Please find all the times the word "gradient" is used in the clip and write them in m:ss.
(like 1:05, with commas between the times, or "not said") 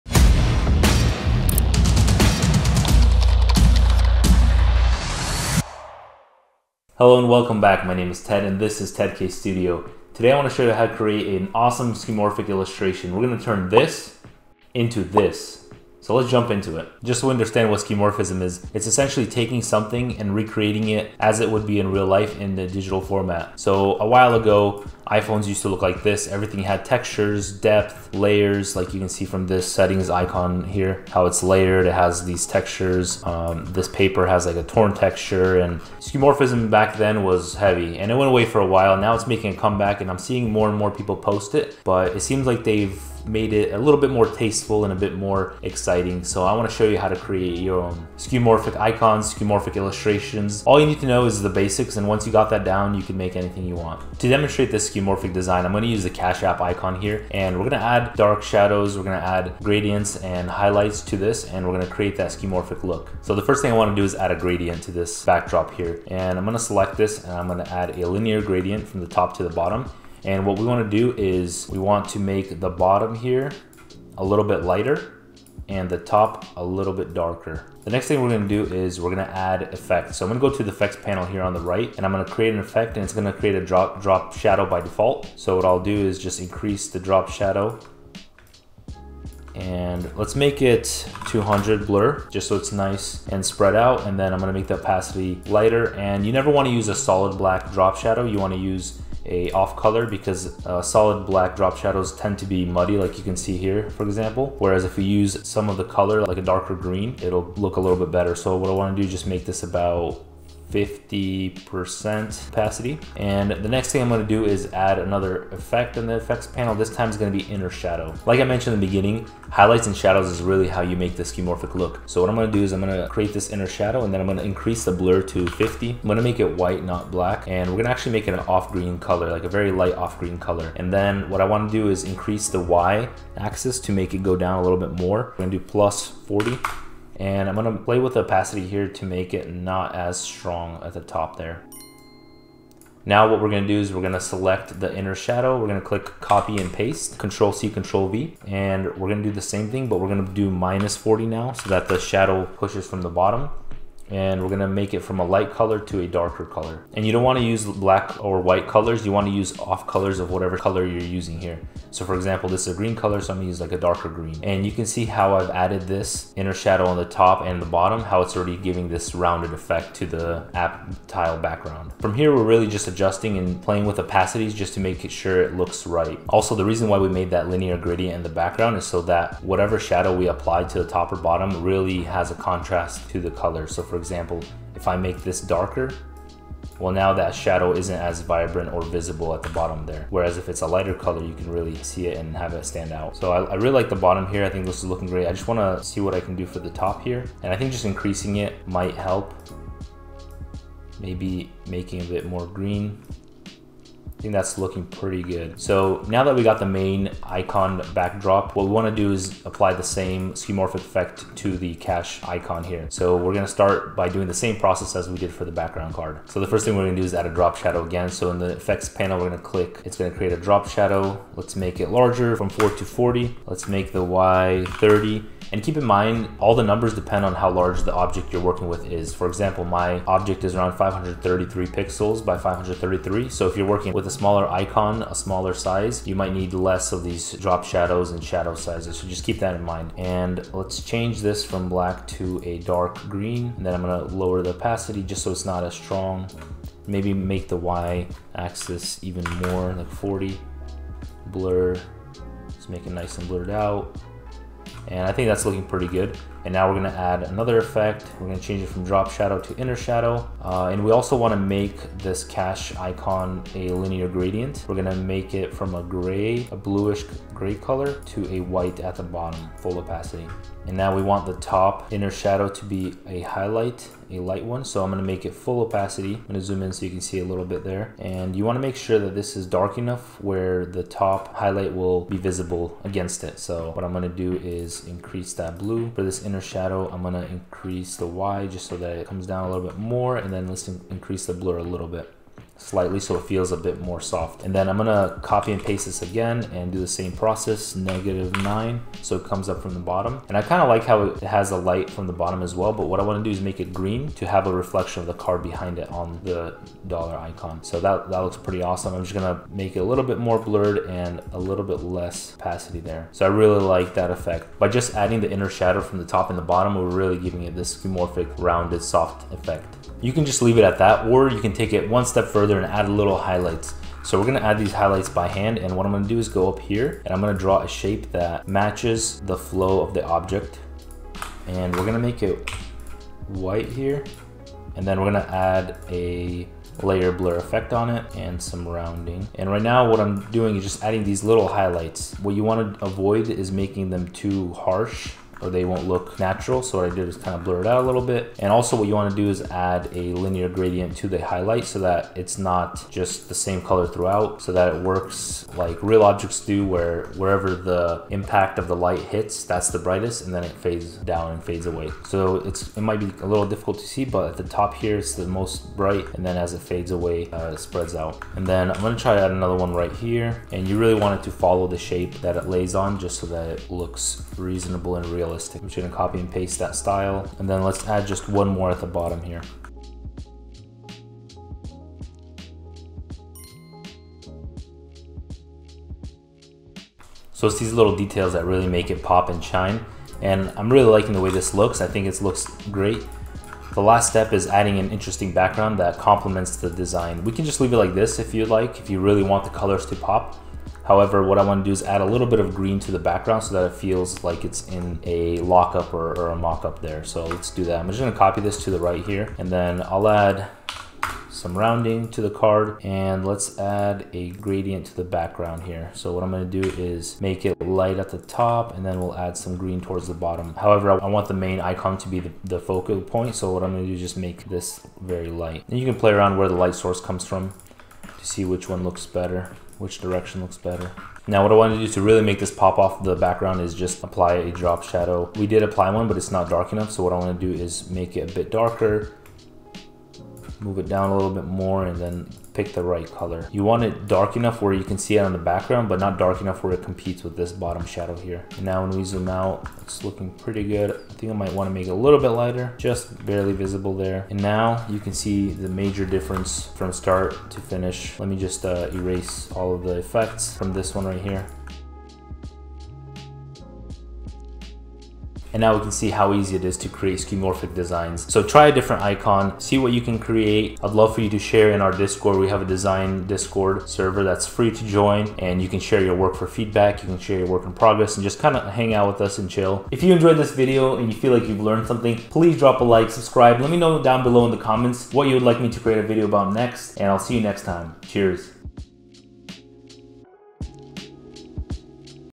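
0:59, 1:04, 1:08, 2:57, 4:24, 5:50, 6:54.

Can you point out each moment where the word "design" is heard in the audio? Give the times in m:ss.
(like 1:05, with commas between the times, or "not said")
0:55, 6:36, 7:47, 7:52.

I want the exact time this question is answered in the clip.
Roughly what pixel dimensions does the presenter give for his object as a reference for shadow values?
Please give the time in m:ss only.
3:50.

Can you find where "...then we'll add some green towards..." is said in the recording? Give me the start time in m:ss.
6:58.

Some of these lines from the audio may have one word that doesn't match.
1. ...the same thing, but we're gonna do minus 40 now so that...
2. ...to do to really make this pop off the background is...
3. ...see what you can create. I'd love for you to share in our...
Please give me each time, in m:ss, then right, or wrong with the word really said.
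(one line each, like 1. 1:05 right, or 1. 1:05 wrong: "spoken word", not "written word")
1. 2:29 right
2. 7:11 right
3. 7:49 right.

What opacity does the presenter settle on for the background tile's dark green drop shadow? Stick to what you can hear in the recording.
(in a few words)
50%.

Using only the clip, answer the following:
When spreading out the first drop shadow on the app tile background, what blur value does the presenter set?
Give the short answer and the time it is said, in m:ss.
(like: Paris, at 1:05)
200, at 1:31.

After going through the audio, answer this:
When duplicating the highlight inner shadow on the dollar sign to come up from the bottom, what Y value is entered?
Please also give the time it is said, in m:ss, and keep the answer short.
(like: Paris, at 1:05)
-9, at 4:57.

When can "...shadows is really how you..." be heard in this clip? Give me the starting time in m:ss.
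1:59.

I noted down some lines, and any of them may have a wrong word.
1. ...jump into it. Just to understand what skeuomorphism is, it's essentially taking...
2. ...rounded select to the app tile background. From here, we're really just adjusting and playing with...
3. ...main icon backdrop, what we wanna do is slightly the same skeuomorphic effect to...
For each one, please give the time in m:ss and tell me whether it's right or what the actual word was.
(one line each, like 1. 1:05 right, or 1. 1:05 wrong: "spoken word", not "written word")
1. 0:16 right
2. 2:49 wrong: "effect", not "select"
3. 3:26 wrong: "apply", not "slightly".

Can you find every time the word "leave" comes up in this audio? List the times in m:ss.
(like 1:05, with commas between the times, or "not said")
5:20, 6:37.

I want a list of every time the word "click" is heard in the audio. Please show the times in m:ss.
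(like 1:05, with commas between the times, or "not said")
2:25, 3:39.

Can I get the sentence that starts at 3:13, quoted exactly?
So I, I really like the bottom here.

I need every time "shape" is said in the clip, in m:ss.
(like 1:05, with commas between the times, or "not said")
5:27, 6:11.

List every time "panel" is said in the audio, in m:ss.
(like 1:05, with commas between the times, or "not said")
1:21, 1:56, 3:38.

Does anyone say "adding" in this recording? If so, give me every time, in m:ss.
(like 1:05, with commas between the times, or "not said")
5:14, 5:40, 6:34.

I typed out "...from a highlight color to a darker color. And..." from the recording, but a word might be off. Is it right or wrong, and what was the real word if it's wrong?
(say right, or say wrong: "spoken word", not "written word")
wrong: "light", not "highlight".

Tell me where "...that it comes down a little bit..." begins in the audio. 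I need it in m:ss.
4:48.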